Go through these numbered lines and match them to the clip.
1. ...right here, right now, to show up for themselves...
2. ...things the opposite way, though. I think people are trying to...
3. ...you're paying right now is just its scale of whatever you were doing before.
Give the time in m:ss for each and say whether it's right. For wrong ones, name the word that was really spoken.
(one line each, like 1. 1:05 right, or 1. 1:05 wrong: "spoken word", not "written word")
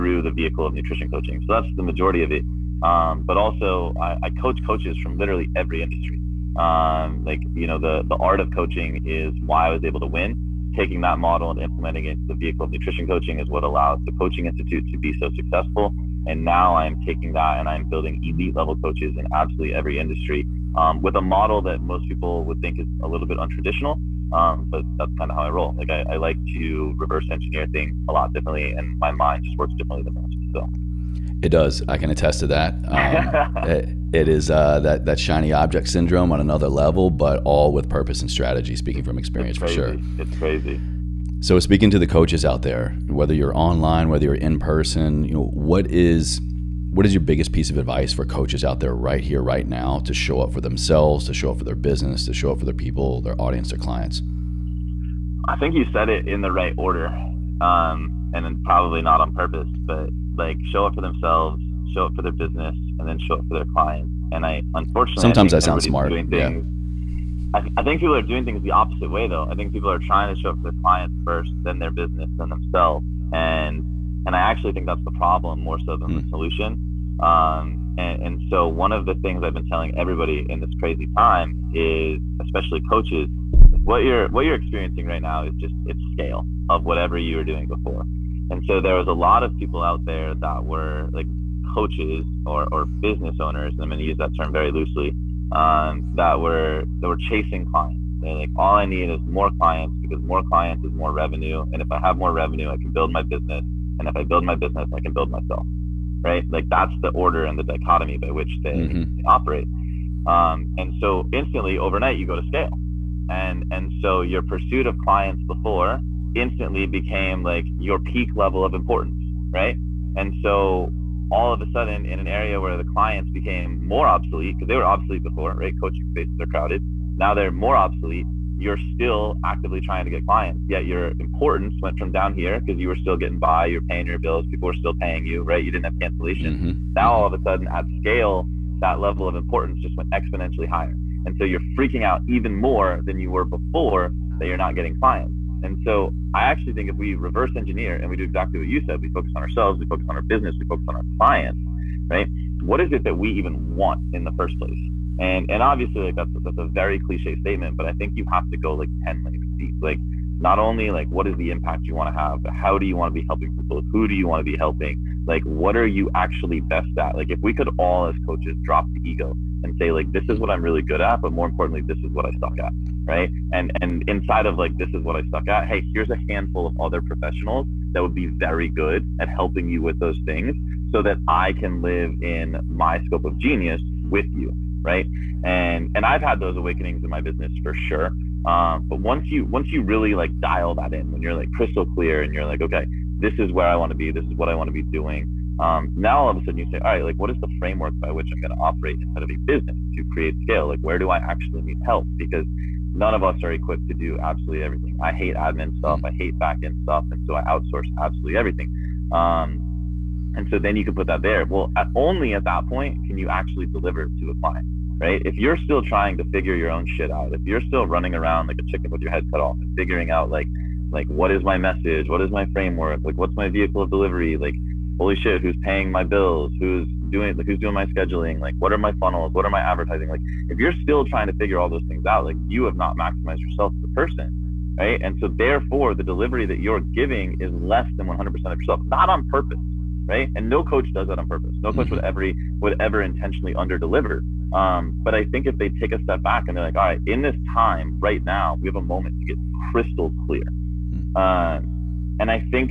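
1. 0:48 right
2. 1:08 right
3. 1:24 wrong: "experiencing", not "paying".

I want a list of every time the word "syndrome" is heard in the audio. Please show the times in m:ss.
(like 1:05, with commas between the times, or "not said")
0:35.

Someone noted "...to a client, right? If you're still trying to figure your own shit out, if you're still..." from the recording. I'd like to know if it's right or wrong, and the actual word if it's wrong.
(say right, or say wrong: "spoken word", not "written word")
right.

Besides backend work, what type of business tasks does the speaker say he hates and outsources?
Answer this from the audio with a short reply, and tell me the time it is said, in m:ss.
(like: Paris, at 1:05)
admin stuff, at 3:25.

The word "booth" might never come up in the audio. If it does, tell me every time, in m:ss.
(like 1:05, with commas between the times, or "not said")
not said.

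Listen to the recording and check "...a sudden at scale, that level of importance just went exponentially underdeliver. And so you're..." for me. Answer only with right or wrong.
wrong.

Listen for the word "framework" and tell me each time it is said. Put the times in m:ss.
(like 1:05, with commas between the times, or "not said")
3:17, 3:42.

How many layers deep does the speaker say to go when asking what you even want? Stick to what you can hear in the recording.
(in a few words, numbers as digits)
10.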